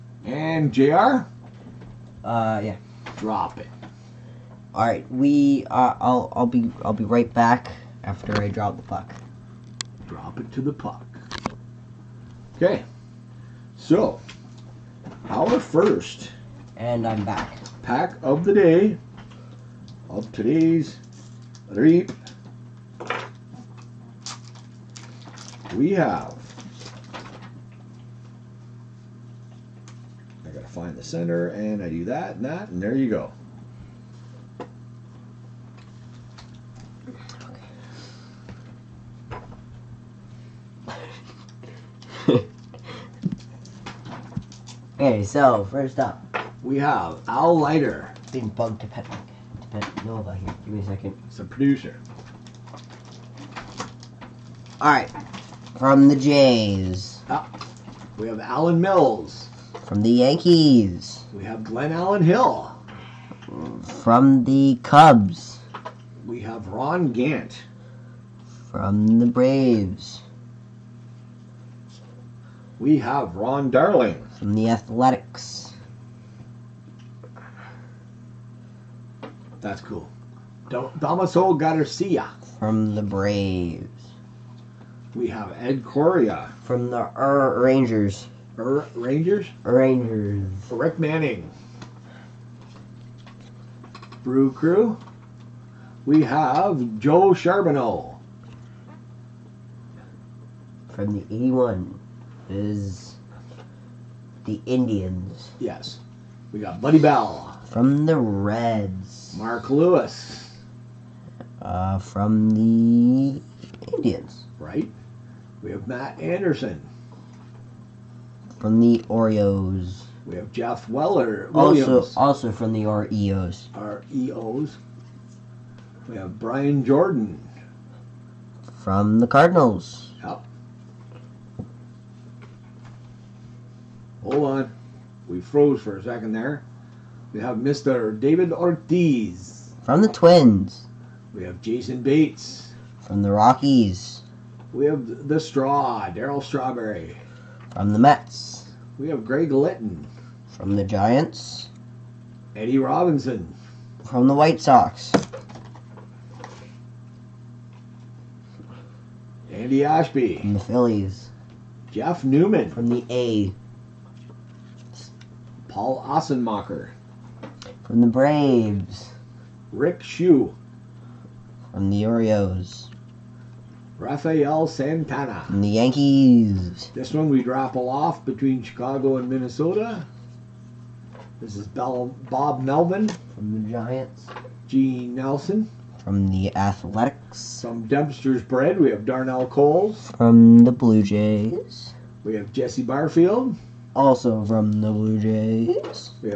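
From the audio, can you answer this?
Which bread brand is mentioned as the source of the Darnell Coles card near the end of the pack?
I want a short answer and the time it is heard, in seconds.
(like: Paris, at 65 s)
Dempster's, at 187 s.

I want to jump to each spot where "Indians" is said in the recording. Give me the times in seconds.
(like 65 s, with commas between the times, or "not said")
104 s, 113 s.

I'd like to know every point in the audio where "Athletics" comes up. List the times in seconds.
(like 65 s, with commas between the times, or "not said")
74 s, 186 s.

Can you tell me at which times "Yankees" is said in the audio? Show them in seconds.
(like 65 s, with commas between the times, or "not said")
60 s, 175 s.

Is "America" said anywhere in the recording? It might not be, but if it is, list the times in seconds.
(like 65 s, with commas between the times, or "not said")
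not said.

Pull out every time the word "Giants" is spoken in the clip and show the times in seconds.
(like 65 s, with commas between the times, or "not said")
150 s, 183 s.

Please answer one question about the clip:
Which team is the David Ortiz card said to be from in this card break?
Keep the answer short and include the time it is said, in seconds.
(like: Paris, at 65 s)
Twins, at 139 s.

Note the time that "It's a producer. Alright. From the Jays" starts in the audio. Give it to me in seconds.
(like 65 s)
51 s.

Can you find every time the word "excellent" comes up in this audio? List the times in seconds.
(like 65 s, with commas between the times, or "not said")
not said.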